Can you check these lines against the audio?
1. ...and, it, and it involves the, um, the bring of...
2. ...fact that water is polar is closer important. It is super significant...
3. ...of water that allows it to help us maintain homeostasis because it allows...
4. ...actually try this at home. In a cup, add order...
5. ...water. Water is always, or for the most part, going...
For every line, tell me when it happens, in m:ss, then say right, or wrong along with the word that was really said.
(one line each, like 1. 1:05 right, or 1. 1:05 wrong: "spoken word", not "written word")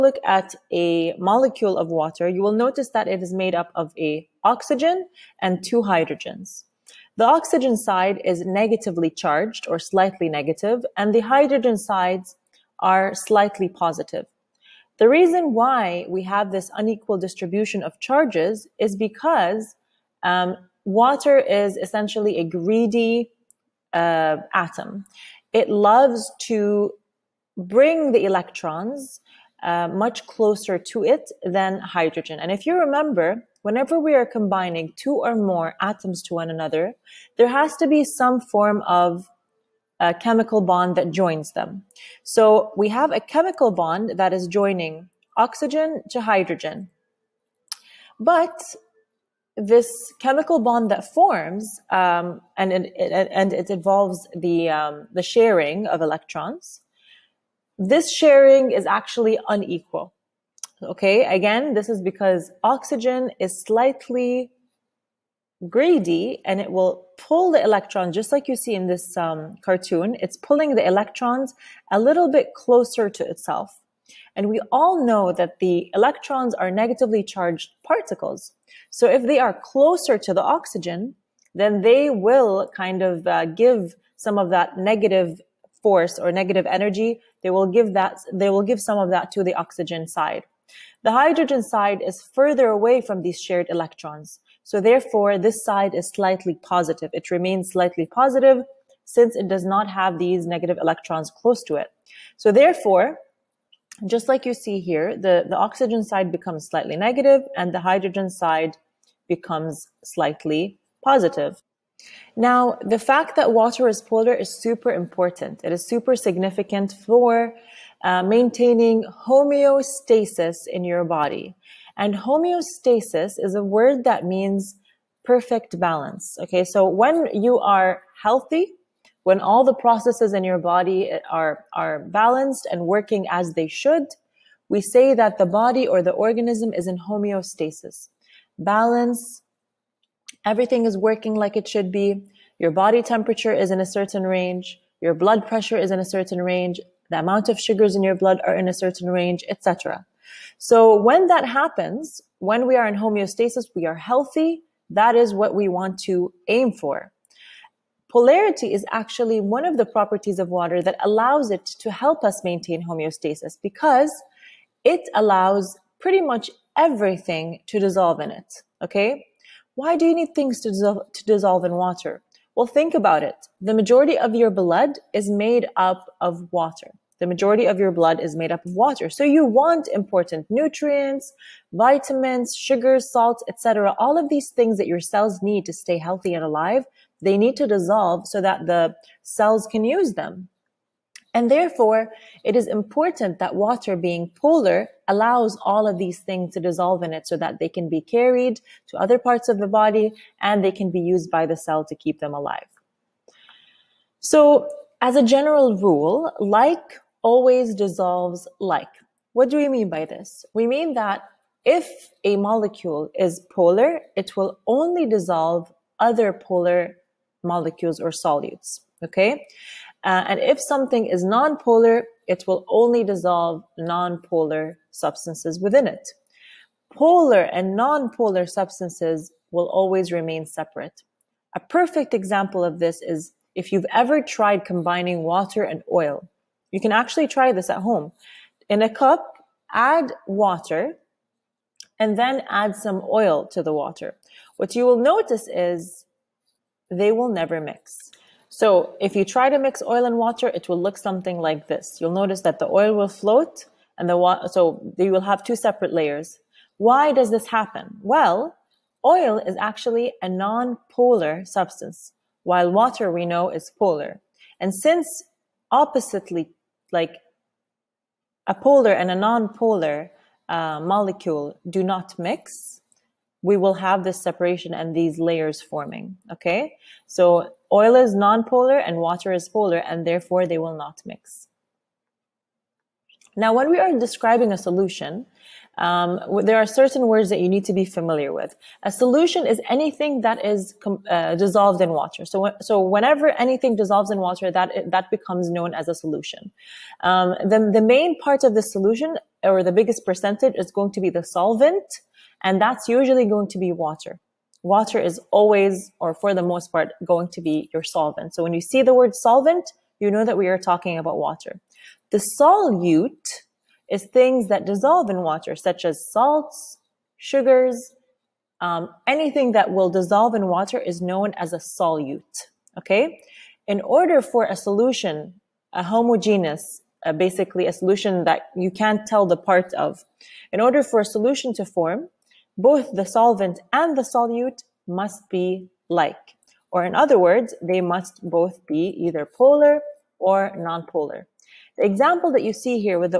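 1. 0:52 wrong: "sharing", not "bring"
2. 1:52 wrong: "super", not "closer"
3. 2:40 right
4. 3:56 wrong: "water", not "order"
5. 5:03 right.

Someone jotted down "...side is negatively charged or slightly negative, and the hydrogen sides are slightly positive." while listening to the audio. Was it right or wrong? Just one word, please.
right.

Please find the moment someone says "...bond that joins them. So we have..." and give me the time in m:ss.
0:40.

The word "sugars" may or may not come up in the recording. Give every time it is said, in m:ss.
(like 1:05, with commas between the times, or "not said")
2:27, 3:02, 5:17.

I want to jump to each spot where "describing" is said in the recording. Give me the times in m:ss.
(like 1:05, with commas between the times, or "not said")
4:43.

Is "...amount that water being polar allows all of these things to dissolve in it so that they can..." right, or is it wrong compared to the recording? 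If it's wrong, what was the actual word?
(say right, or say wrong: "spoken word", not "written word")
wrong: "important", not "amount".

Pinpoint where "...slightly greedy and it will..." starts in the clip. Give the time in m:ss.
1:03.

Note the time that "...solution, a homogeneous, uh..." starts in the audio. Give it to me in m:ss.
5:24.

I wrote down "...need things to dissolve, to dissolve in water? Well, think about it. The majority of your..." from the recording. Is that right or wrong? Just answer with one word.
right.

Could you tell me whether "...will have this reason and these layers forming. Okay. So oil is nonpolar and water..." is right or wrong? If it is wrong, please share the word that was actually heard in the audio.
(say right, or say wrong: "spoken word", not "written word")
wrong: "separation", not "reason".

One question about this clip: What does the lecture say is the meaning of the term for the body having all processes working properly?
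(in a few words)
perfect balance.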